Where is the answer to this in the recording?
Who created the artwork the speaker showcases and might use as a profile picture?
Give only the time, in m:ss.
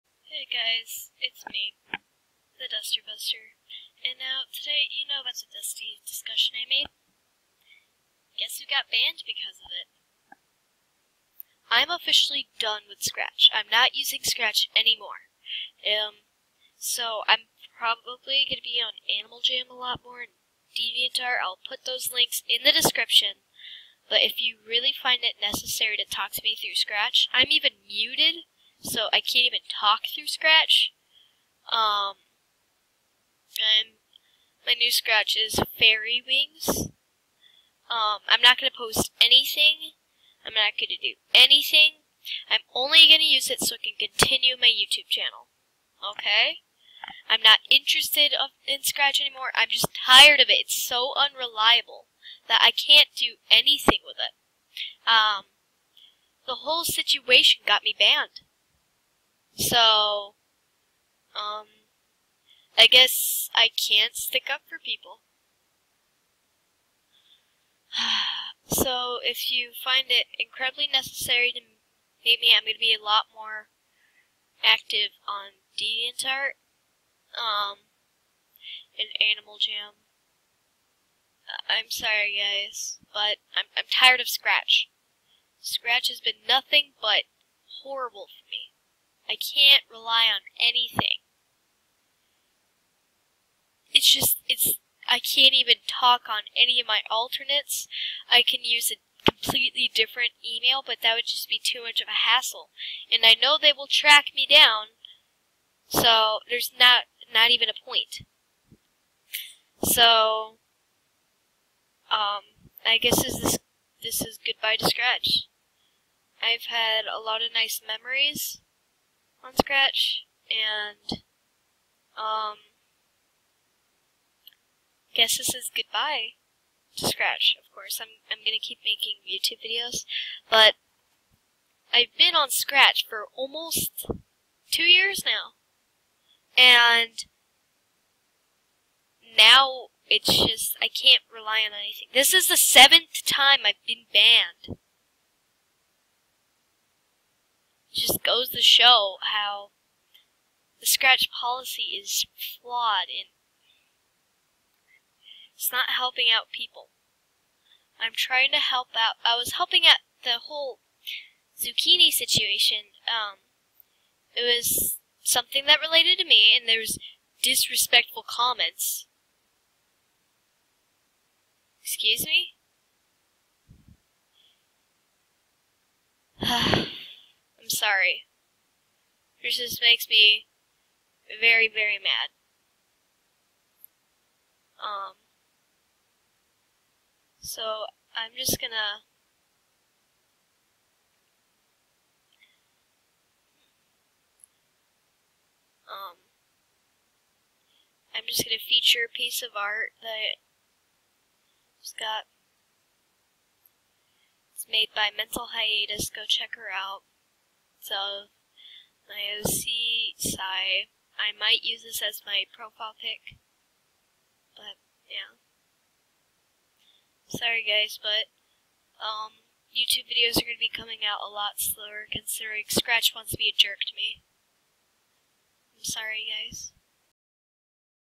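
3:25.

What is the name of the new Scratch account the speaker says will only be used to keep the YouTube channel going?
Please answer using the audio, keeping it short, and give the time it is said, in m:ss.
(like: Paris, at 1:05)
Fairy Wings, at 0:35.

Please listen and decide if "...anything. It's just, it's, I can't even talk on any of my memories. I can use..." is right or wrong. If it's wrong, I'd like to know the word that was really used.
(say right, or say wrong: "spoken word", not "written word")
wrong: "alternates", not "memories".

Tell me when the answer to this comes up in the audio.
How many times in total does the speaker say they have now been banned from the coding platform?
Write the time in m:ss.
2:22.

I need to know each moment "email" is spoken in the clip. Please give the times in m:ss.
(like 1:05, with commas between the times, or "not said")
1:40.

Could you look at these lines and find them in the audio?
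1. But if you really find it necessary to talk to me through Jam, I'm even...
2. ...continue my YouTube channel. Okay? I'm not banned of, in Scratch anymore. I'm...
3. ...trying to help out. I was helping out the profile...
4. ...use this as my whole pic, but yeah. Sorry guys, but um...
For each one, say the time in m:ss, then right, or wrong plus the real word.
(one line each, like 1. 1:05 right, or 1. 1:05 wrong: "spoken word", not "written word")
1. 0:24 wrong: "Scratch", not "Jam"
2. 0:43 wrong: "interested", not "banned"
3. 2:38 wrong: "whole", not "profile"
4. 3:31 wrong: "profile", not "whole".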